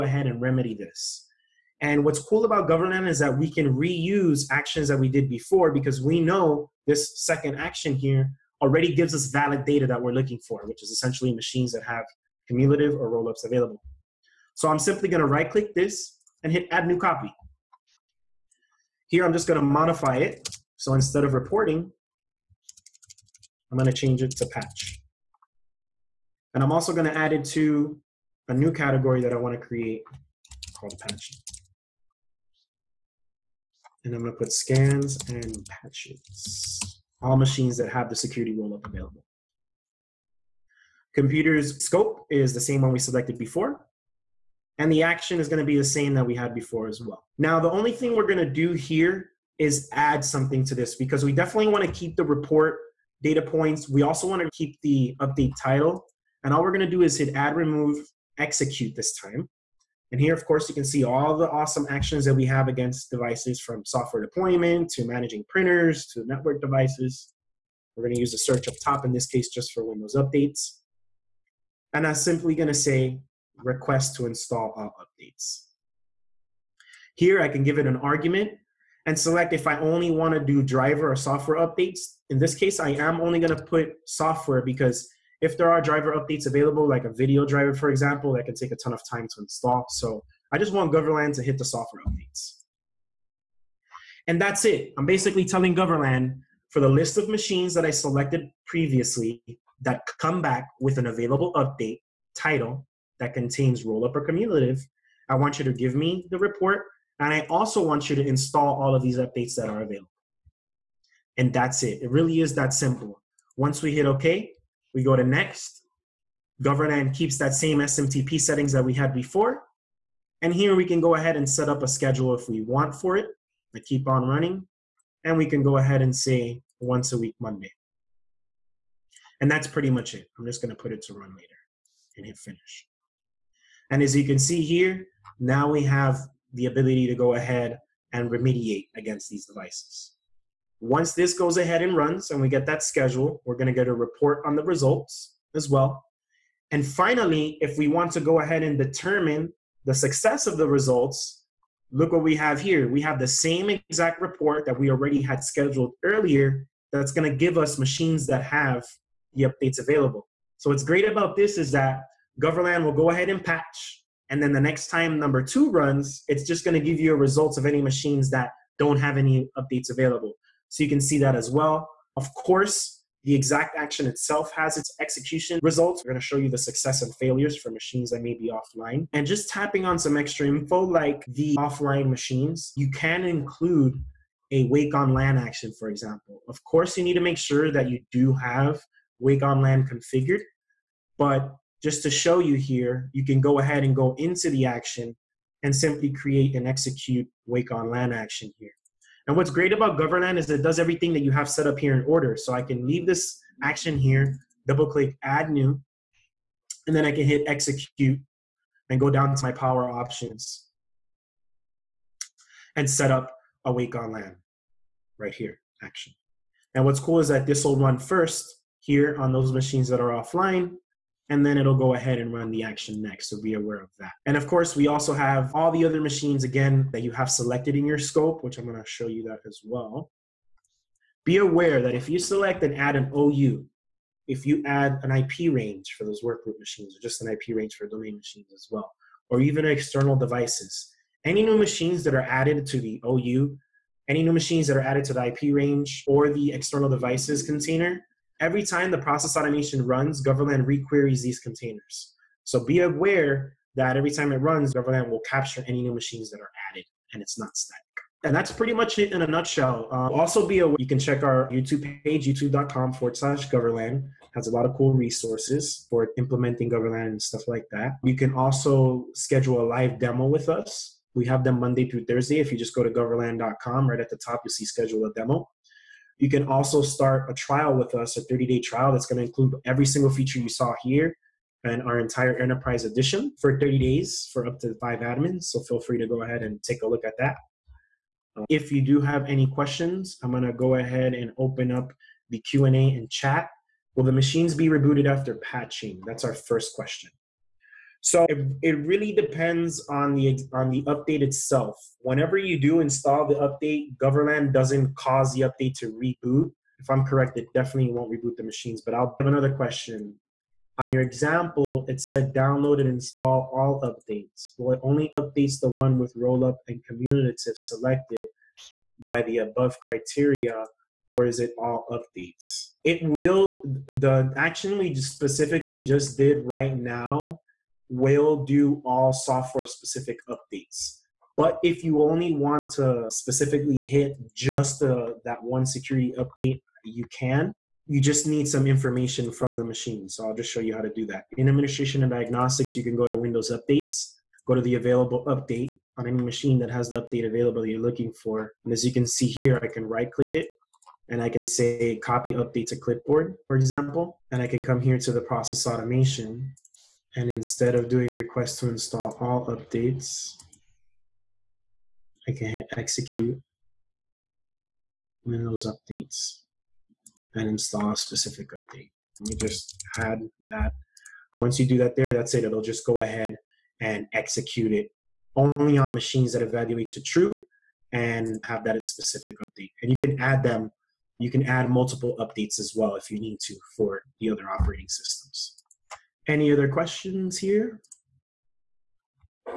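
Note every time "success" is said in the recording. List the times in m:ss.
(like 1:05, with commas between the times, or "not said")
2:29, 2:56.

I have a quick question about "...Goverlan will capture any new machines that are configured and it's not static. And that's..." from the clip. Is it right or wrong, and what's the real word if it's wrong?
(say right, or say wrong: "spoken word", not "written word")
wrong: "added", not "configured".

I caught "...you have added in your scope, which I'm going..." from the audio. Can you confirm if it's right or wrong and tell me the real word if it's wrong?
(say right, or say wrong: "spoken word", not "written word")
wrong: "selected", not "added".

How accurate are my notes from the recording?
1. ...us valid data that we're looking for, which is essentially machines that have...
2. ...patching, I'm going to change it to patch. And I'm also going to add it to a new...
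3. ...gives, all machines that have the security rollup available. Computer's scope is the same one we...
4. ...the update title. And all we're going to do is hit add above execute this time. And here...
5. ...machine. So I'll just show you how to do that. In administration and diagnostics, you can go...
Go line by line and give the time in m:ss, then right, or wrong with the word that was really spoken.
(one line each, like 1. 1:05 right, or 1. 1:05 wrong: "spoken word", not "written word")
1. 0:09 right
2. 0:21 wrong: "reporting", not "patching"
3. 0:35 wrong: "patches", not "gives"
4. 0:54 wrong: "remove", not "above"
5. 5:39 right.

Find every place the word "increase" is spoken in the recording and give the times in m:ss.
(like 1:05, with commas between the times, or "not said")
not said.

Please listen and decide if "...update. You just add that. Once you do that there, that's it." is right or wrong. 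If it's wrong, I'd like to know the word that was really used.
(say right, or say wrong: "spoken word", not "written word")
right.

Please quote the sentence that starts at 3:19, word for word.
And what's great about Goverlan is it does everything that you have set up here in order.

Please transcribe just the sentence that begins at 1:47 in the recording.
And I also want you to install all of these updates that are available.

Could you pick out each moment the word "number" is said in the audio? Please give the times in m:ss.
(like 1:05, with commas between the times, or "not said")
2:45.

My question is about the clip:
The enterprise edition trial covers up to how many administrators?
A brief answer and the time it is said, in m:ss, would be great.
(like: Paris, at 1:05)
5, at 4:44.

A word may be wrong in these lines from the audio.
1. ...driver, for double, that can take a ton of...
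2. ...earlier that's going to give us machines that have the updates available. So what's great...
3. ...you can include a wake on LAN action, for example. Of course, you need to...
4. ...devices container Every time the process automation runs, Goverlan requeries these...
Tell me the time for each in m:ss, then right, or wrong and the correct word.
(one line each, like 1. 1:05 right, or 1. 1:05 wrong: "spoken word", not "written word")
1. 1:27 wrong: "example", not "double"
2. 2:36 right
3. 3:02 right
4. 4:06 right.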